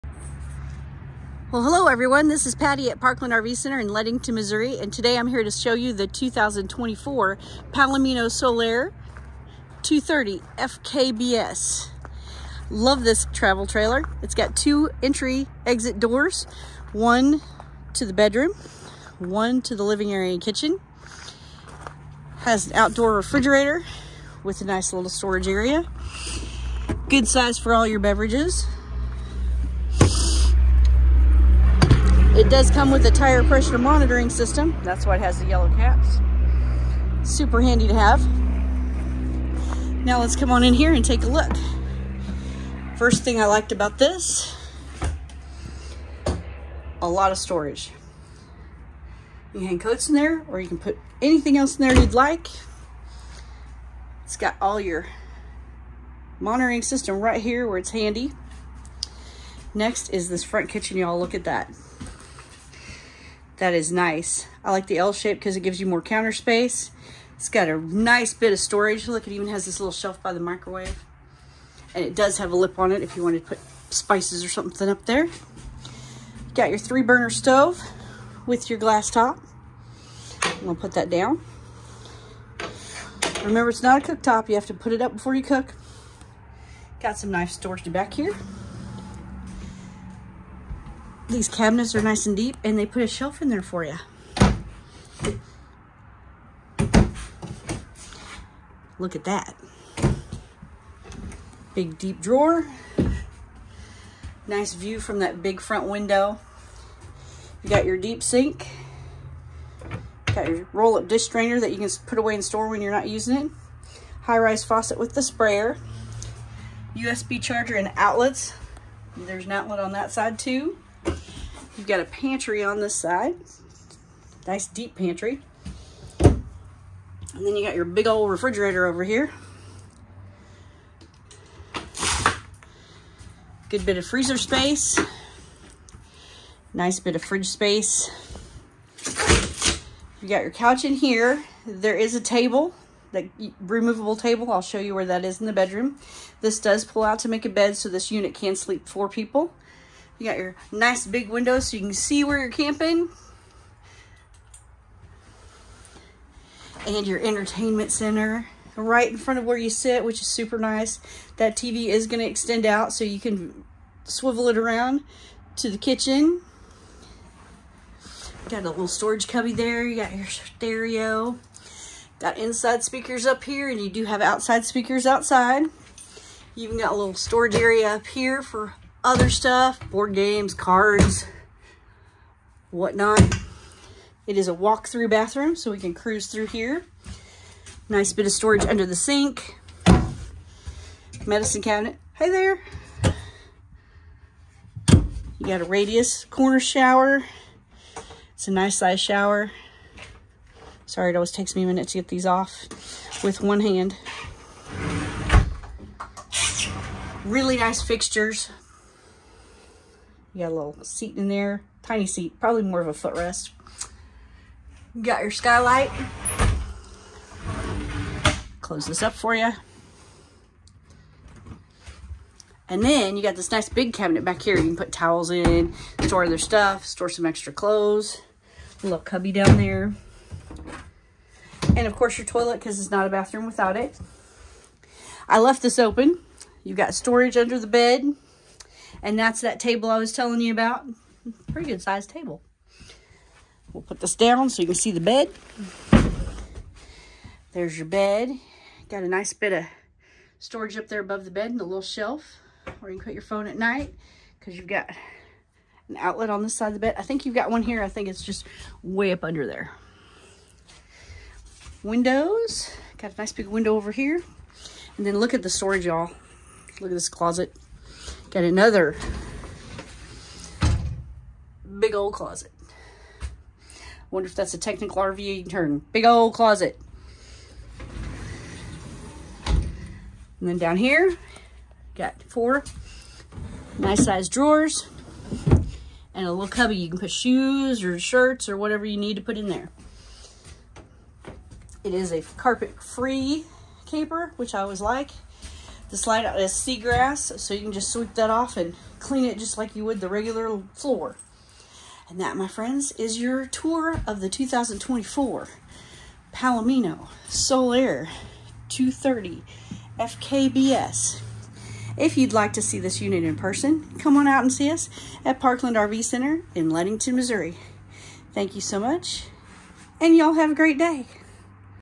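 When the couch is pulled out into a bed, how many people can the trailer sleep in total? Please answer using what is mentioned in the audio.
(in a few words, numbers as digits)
4.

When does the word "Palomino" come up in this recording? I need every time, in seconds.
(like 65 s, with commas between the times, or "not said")
7 s, 306 s.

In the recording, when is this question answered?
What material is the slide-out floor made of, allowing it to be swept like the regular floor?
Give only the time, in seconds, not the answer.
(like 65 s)
296 s.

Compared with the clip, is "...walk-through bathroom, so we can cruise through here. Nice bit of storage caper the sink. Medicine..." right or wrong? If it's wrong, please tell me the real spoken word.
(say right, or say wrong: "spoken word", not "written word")
wrong: "under", not "caper".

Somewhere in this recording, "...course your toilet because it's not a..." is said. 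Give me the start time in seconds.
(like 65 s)
231 s.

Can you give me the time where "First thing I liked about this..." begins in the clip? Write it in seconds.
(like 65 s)
42 s.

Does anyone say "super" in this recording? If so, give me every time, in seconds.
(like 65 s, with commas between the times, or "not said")
37 s, 160 s.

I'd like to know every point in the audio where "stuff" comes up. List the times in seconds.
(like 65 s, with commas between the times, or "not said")
179 s, 226 s.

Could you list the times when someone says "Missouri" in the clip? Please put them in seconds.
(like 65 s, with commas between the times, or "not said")
4 s, 317 s.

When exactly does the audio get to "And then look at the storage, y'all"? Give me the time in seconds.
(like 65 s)
264 s.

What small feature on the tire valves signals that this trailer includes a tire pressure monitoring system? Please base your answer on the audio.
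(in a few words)
yellow caps.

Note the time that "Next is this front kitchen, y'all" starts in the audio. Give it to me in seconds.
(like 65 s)
59 s.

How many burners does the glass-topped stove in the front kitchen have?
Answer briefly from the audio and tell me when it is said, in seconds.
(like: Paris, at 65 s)
3, at 76 s.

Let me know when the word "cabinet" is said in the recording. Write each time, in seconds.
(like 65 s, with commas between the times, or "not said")
91 s, 191 s, 223 s.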